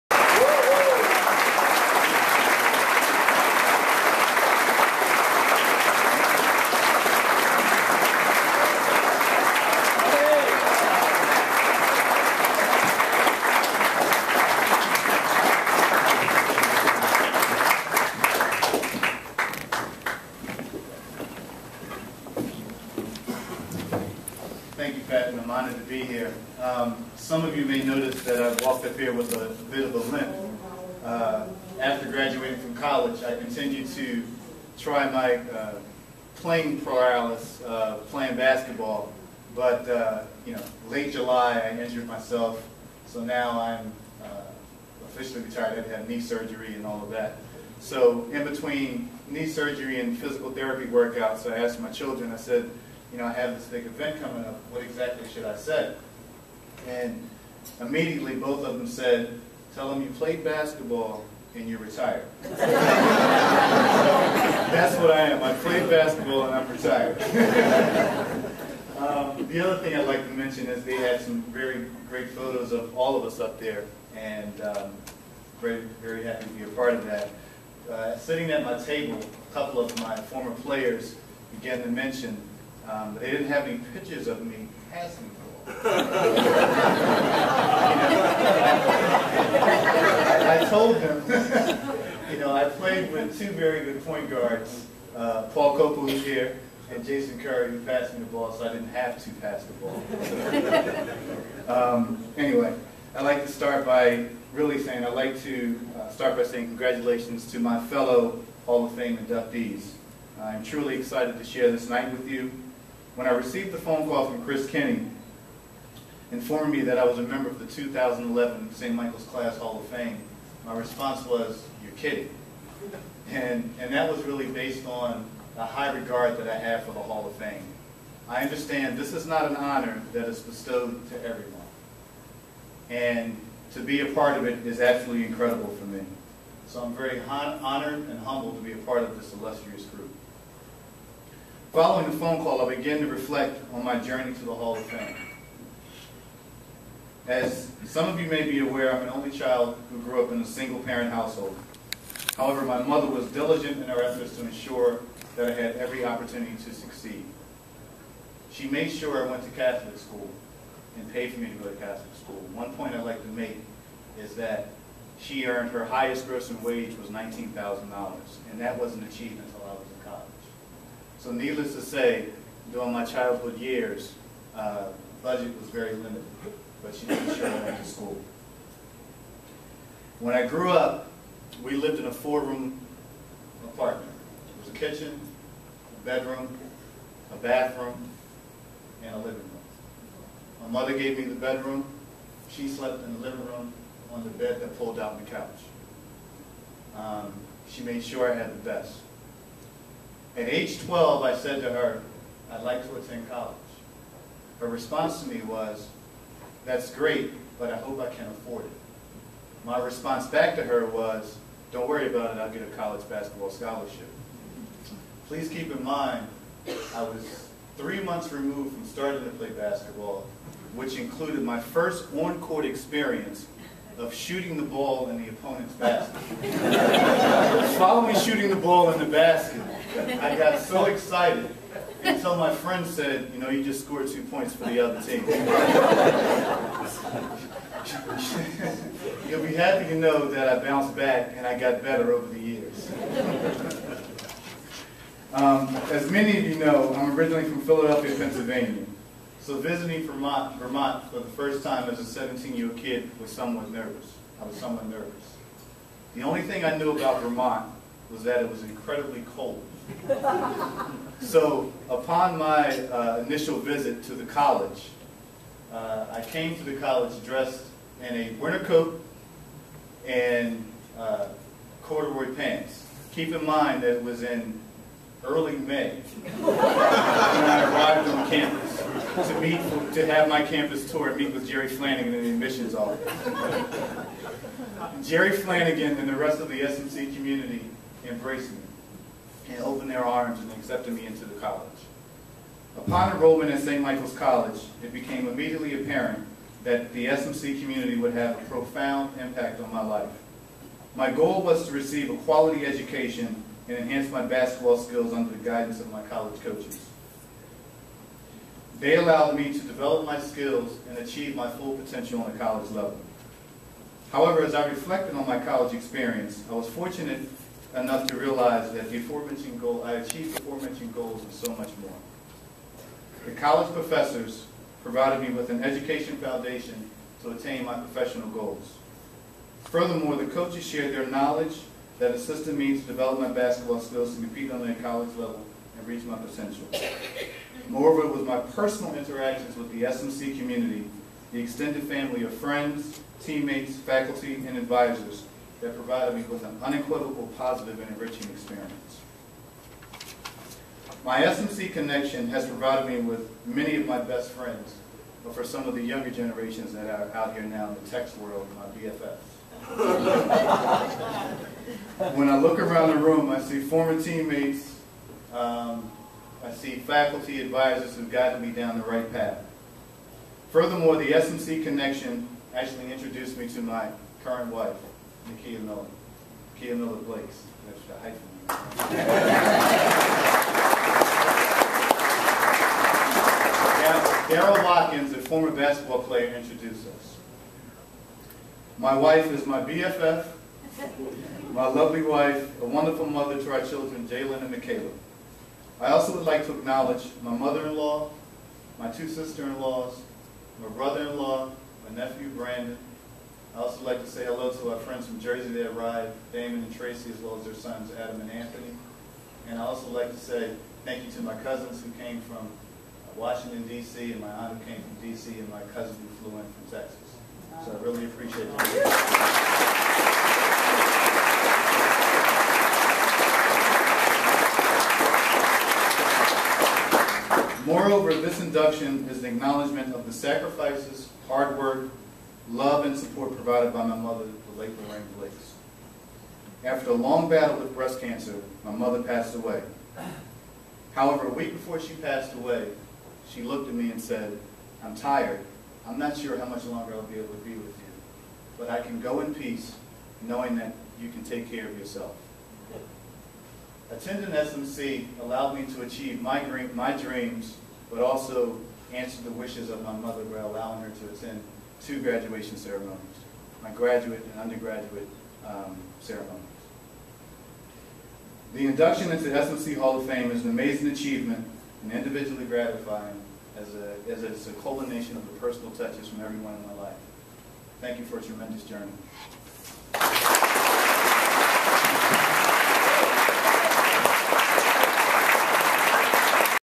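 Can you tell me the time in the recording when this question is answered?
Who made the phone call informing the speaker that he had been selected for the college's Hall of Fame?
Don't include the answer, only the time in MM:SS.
01:54.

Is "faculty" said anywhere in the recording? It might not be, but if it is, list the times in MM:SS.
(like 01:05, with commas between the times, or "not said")
05:43, 06:06.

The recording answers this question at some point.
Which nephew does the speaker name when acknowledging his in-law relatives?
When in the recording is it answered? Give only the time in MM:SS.
06:42.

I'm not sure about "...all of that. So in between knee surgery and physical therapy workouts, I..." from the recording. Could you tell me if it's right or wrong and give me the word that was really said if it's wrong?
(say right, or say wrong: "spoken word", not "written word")
right.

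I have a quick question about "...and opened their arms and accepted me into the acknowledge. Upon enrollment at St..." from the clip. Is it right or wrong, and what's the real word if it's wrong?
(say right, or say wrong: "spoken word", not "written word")
wrong: "college", not "acknowledge".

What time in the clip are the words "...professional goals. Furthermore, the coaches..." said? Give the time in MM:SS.
05:27.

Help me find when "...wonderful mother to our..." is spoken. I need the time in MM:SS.
06:32.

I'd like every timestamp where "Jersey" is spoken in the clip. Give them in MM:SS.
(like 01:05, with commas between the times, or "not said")
06:45.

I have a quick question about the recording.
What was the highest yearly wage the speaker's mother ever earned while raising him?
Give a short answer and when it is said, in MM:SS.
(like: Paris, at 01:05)
$19,000, at 02:47.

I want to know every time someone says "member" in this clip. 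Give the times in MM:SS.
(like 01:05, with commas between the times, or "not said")
01:57.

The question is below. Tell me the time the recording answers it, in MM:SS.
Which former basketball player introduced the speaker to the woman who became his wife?
06:24.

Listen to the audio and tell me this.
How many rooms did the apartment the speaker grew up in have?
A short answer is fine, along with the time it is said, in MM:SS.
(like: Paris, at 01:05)
4, at 03:02.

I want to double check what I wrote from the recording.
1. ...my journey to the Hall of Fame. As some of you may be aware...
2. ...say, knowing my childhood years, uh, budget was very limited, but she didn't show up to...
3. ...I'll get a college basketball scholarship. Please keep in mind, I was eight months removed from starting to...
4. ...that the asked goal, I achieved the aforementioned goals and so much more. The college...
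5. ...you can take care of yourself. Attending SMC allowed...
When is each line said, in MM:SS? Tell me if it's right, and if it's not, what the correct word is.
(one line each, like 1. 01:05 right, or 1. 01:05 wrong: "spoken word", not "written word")
1. 02:23 right
2. 02:51 wrong: "during", not "knowing"
3. 03:32 wrong: "three", not "eight"
4. 05:18 wrong: "aforementioned", not "asked"
5. 07:31 right.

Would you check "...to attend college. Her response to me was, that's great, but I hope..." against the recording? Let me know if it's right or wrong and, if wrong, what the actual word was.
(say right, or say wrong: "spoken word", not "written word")
right.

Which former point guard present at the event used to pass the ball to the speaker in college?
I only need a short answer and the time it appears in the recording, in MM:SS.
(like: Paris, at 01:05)
Paul Copa, at 01:35.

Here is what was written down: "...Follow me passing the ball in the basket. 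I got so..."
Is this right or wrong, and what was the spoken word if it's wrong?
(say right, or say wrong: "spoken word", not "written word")
wrong: "shooting", not "passing".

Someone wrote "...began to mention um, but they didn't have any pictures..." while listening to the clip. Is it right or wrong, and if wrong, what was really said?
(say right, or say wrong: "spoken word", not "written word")
right.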